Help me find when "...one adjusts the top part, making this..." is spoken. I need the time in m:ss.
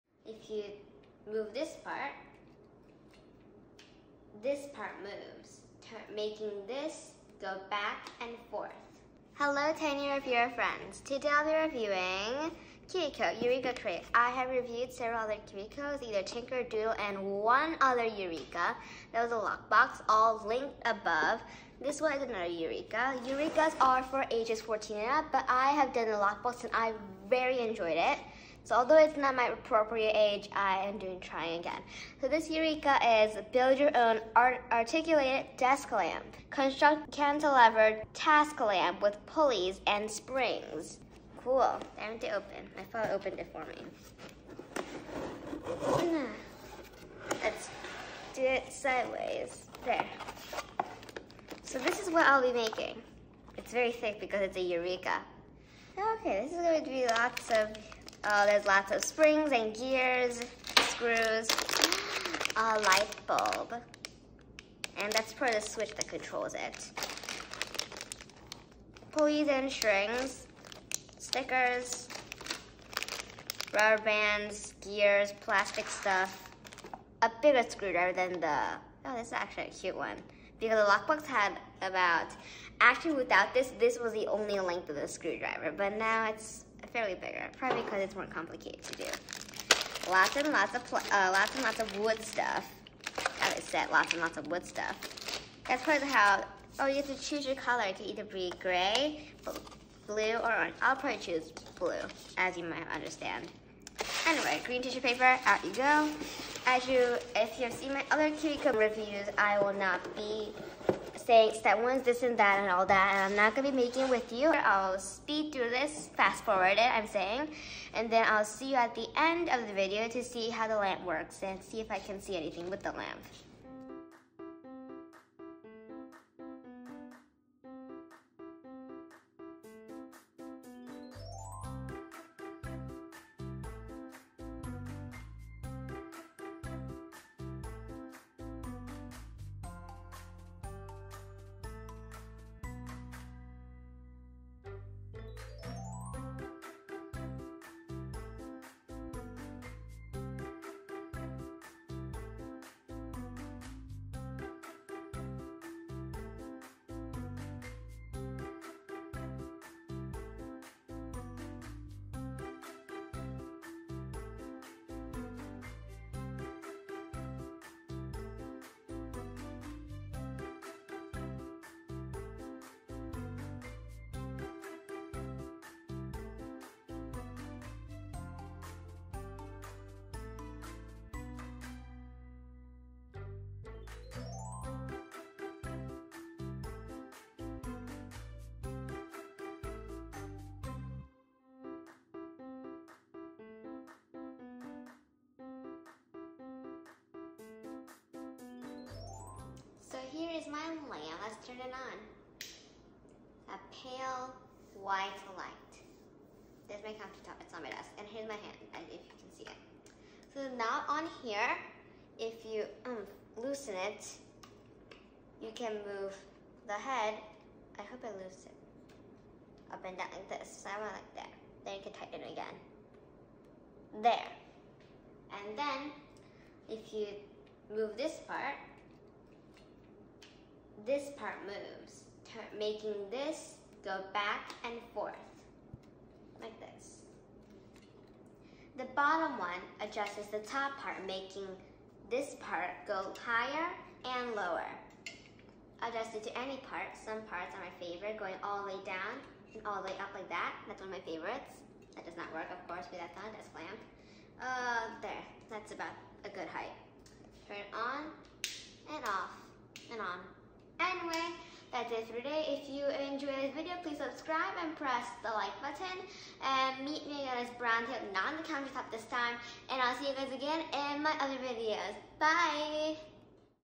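3:59.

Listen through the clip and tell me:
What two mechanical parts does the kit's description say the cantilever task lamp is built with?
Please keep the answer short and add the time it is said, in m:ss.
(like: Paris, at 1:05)
pulleys and springs, at 0:39.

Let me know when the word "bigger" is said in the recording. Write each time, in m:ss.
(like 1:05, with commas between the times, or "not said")
1:17, 1:27.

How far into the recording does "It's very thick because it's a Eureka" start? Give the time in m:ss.
0:53.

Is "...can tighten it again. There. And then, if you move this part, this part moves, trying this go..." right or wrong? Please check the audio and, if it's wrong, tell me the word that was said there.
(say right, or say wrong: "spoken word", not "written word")
wrong: "making", not "trying".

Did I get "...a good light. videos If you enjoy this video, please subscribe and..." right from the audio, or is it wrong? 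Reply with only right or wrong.
wrong.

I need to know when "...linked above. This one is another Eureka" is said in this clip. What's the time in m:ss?
0:20.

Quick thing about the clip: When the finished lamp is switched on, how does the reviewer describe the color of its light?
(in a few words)
pale white.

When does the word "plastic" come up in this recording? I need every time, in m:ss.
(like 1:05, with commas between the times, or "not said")
1:15.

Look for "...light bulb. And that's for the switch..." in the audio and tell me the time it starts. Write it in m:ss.
1:02.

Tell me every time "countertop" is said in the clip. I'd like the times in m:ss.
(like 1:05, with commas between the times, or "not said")
3:26, 4:28.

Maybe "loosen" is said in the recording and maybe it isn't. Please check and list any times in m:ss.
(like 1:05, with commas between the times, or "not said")
3:33, 3:38.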